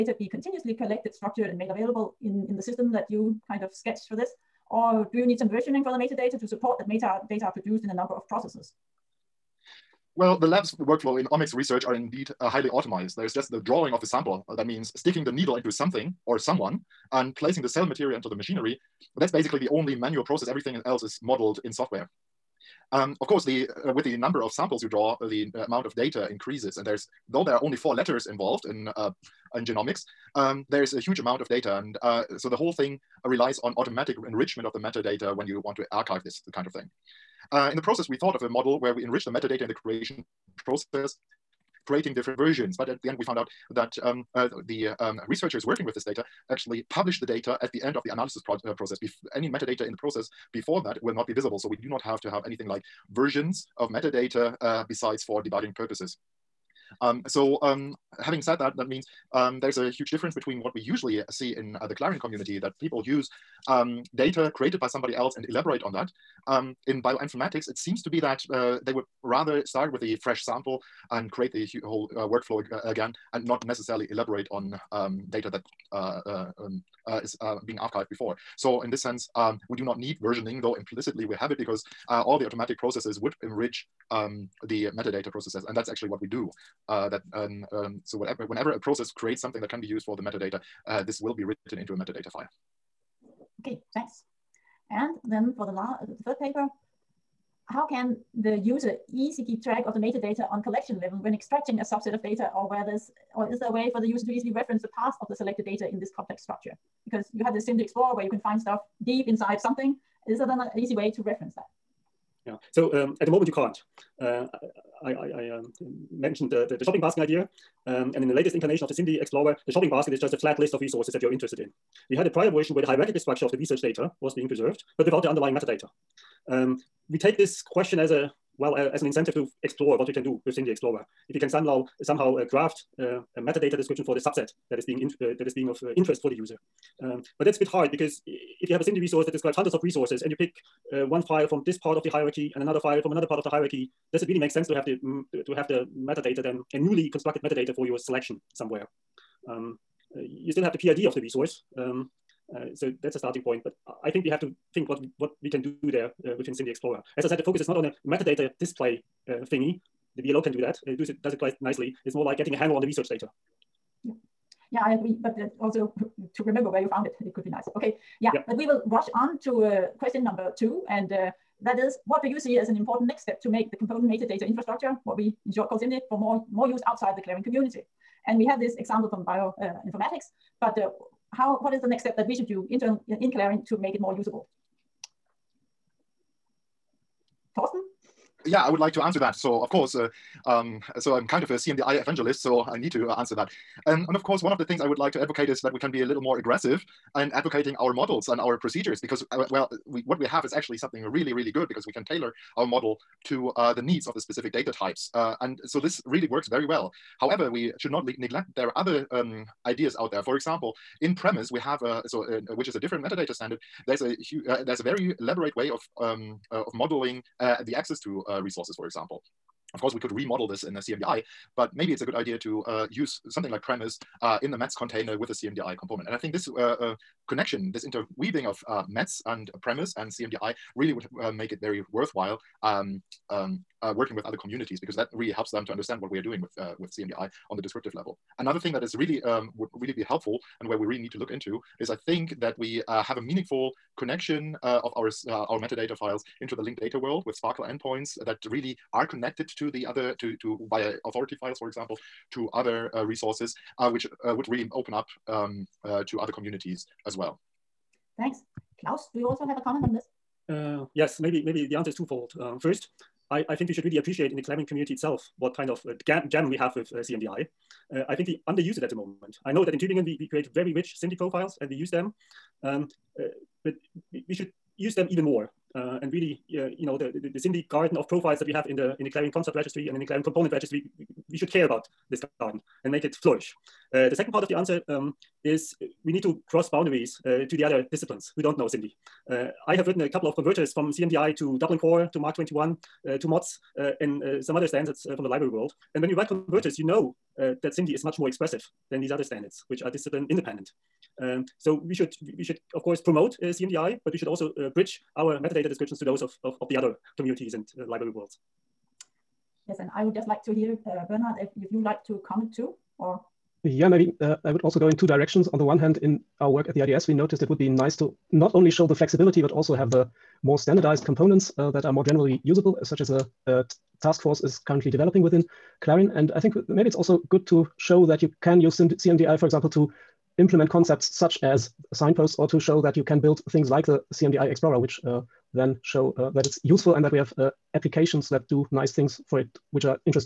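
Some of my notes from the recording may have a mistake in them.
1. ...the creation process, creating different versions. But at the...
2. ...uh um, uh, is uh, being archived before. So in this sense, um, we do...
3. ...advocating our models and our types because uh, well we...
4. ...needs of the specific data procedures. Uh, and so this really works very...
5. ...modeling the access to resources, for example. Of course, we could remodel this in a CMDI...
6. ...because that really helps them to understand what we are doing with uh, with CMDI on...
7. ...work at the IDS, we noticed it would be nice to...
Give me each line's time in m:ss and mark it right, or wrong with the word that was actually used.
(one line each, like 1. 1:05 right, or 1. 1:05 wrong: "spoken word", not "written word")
1. 0:39 right
2. 1:16 right
3. 3:17 wrong: "procedures", not "types"
4. 3:23 wrong: "types", not "procedures"
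5. 3:36 right
6. 3:54 right
7. 5:16 right.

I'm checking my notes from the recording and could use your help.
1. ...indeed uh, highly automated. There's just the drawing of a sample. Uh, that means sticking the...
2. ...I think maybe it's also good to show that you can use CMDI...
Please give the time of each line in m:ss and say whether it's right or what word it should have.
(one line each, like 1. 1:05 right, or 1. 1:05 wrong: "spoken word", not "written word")
1. 0:11 right
2. 5:26 right.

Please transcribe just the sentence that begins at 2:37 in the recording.
As I said, the focus is not on a metadata display uh, thingy, the VLO can do that.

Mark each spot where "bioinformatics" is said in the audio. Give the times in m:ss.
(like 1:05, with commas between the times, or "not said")
1:07, 2:59.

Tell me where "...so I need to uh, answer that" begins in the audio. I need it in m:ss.
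3:12.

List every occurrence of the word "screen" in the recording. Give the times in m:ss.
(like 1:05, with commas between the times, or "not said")
not said.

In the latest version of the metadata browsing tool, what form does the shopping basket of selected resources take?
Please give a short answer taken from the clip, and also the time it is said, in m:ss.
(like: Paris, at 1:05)
A flat list, at 2:00.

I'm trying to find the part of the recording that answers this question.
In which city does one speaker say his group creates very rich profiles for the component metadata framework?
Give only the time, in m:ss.
4:29.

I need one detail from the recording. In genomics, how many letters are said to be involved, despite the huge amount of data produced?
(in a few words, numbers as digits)
4.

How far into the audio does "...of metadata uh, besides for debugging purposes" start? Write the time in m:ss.
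0:53.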